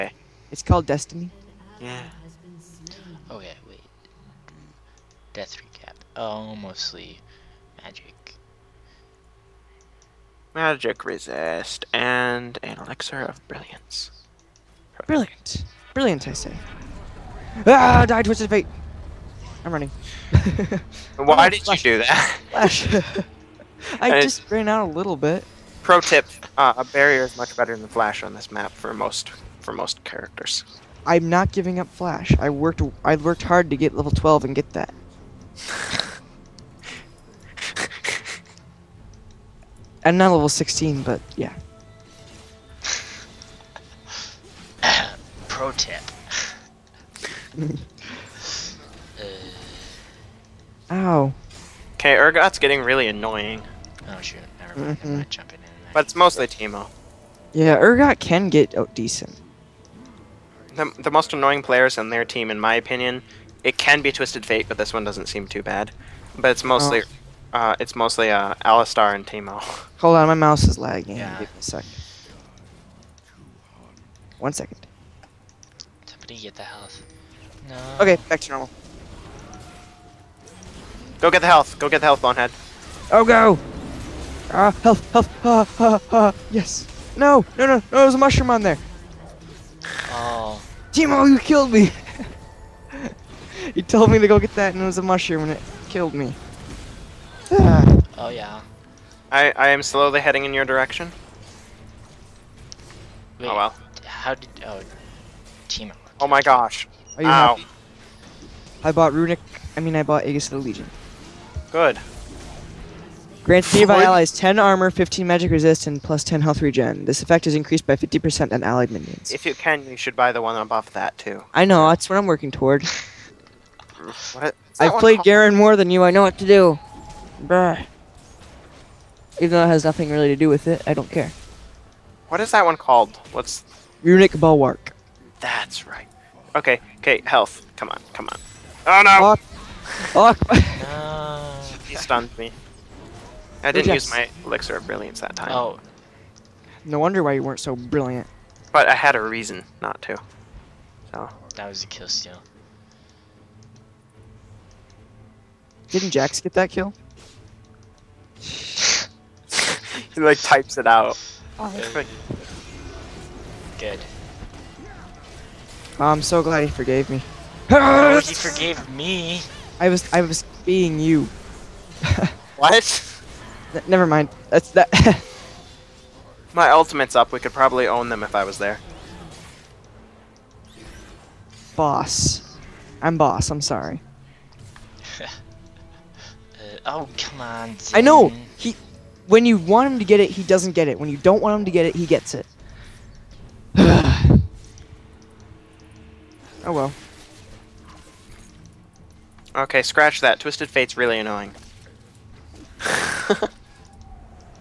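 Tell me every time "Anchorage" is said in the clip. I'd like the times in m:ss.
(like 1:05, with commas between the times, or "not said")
not said.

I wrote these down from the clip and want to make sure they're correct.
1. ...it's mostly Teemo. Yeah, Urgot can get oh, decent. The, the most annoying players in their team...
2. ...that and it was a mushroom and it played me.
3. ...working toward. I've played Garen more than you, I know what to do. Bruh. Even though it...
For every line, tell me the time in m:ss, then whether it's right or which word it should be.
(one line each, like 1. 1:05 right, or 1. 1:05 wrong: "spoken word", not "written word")
1. 0:56 right
2. 1:34 wrong: "killed", not "played"
3. 2:02 right.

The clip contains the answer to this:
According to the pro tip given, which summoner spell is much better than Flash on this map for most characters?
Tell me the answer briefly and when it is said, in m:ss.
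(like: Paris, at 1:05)
Barrier, at 0:26.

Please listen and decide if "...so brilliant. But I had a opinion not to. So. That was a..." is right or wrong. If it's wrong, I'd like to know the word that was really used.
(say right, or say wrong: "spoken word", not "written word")
wrong: "reason", not "opinion".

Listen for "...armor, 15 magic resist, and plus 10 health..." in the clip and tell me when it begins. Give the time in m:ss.
1:54.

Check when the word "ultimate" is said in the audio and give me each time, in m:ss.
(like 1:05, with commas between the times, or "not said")
2:56.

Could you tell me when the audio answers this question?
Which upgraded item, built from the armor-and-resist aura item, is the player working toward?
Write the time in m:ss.
2:14.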